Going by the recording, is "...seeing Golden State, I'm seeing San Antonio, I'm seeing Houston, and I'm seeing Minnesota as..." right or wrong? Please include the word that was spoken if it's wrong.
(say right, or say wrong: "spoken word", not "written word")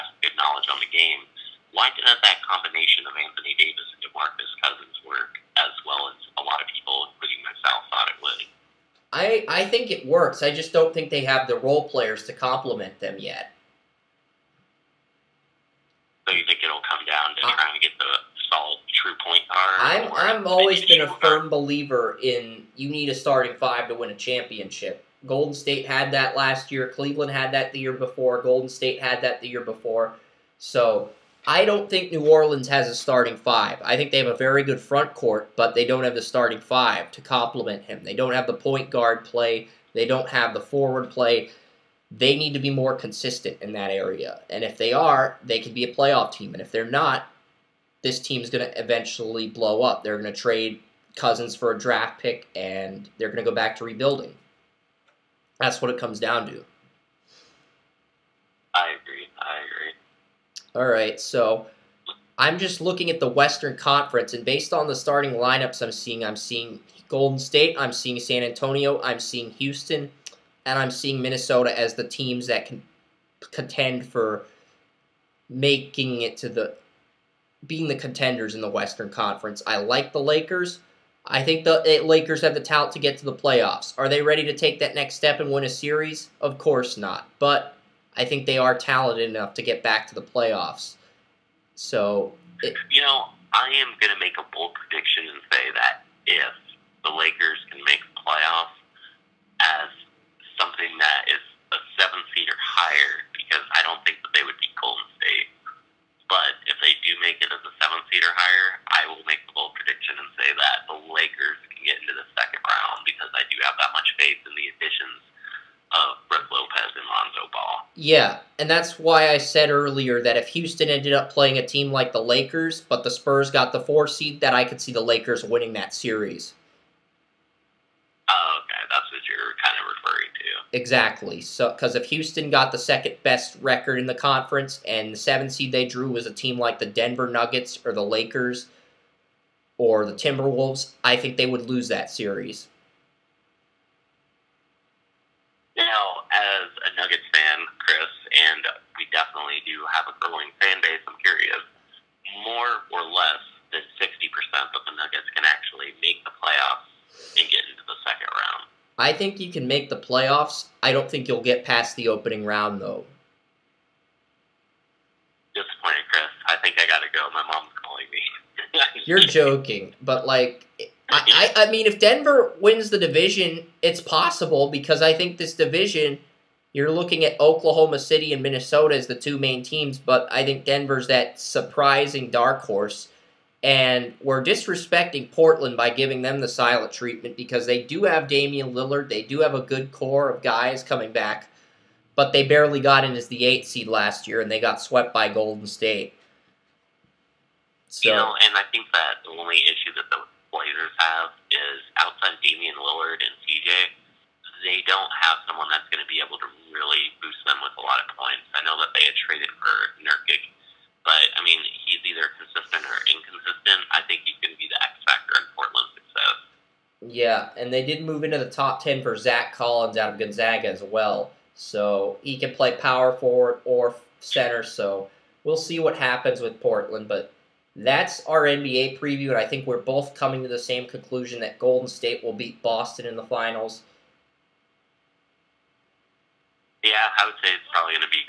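right.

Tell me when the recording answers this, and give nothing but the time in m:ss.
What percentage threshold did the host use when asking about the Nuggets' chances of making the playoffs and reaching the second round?
2:34.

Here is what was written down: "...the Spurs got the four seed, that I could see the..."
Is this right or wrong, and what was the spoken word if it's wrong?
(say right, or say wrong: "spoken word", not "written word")
right.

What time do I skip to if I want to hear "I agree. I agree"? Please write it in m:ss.
0:58.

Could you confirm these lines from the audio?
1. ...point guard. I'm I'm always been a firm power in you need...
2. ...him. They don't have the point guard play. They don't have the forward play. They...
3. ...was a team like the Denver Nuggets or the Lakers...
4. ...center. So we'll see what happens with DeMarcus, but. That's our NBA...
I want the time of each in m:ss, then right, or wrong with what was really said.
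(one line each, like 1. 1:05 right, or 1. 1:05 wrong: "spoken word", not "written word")
1. 0:19 wrong: "believer", not "power"
2. 0:37 right
3. 2:16 right
4. 3:44 wrong: "Portland", not "DeMarcus".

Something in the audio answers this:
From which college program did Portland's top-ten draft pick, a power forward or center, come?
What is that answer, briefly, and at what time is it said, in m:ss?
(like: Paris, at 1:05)
Gonzaga, at 3:40.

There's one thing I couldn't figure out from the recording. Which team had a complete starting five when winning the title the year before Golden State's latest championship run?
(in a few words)
Cleveland.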